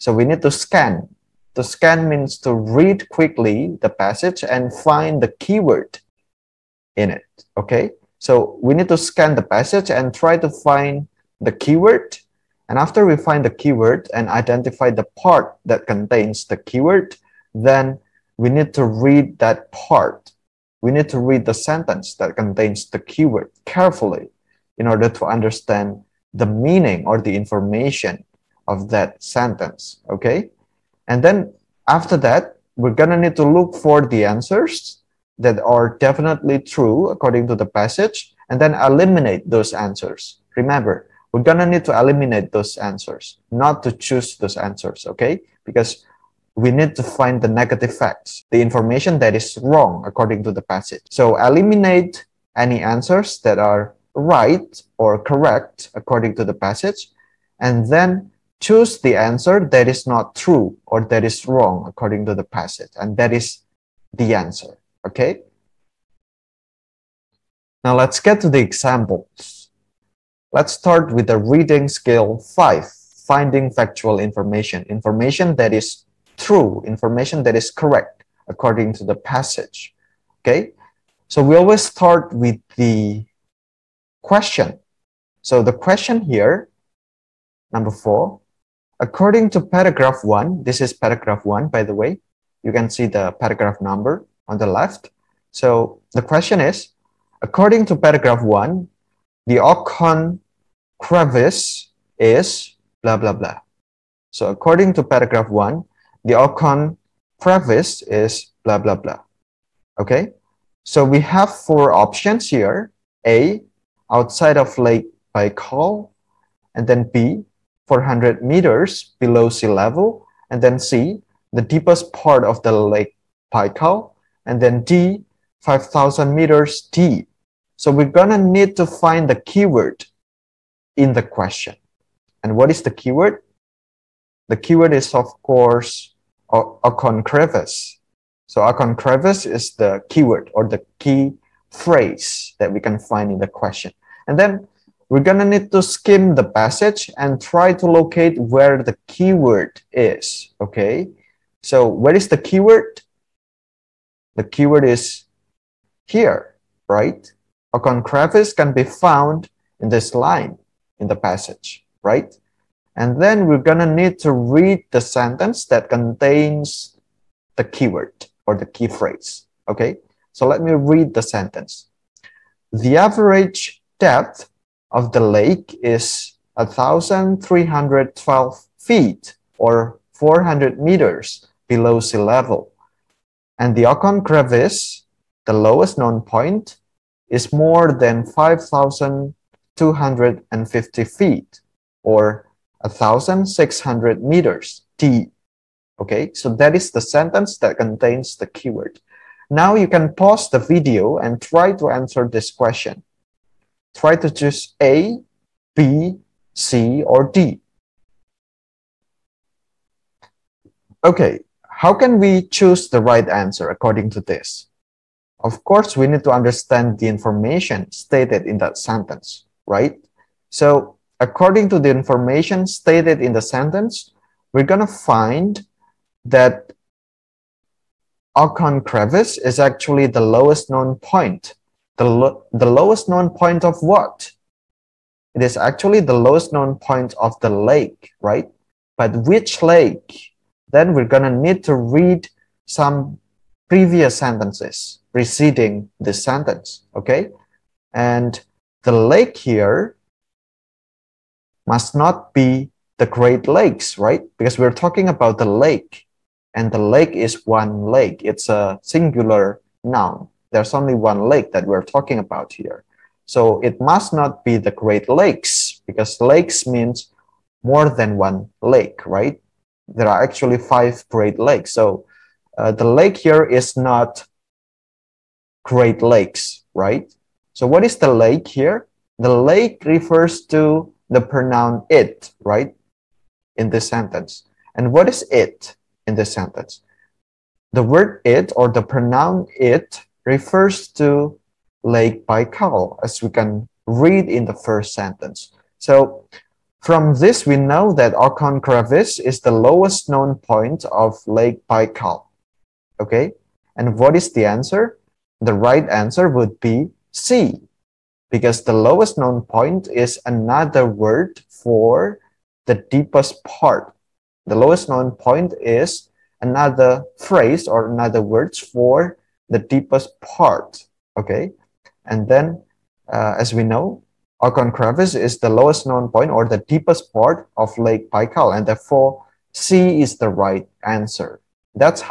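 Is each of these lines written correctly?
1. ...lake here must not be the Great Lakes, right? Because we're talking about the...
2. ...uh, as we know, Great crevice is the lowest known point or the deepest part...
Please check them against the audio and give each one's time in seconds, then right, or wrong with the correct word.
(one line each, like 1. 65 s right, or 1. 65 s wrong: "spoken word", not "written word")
1. 248 s right
2. 323 s wrong: "Okon", not "Great".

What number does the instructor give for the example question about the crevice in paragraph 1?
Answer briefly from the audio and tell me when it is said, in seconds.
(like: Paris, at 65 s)
4, at 87 s.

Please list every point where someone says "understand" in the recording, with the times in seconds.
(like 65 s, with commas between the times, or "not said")
25 s, 216 s.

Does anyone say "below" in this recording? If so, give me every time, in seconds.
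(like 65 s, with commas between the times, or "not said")
119 s, 181 s.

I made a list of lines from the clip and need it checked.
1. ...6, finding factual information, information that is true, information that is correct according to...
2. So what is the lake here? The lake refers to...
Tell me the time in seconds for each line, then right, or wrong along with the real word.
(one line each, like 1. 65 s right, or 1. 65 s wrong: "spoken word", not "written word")
1. 72 s wrong: "5", not "6"
2. 277 s right.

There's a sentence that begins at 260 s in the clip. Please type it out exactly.
There's only one lake that we're talking about here.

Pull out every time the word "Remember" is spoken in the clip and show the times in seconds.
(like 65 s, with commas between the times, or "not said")
40 s.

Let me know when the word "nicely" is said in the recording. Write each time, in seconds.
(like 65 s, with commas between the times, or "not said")
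not said.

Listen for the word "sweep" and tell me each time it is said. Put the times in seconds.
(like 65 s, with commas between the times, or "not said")
not said.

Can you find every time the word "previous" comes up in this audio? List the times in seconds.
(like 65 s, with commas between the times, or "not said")
243 s.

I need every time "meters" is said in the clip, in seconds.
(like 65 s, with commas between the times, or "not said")
118 s, 126 s, 180 s, 194 s.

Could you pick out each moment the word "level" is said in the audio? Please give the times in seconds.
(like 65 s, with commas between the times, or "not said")
119 s, 182 s.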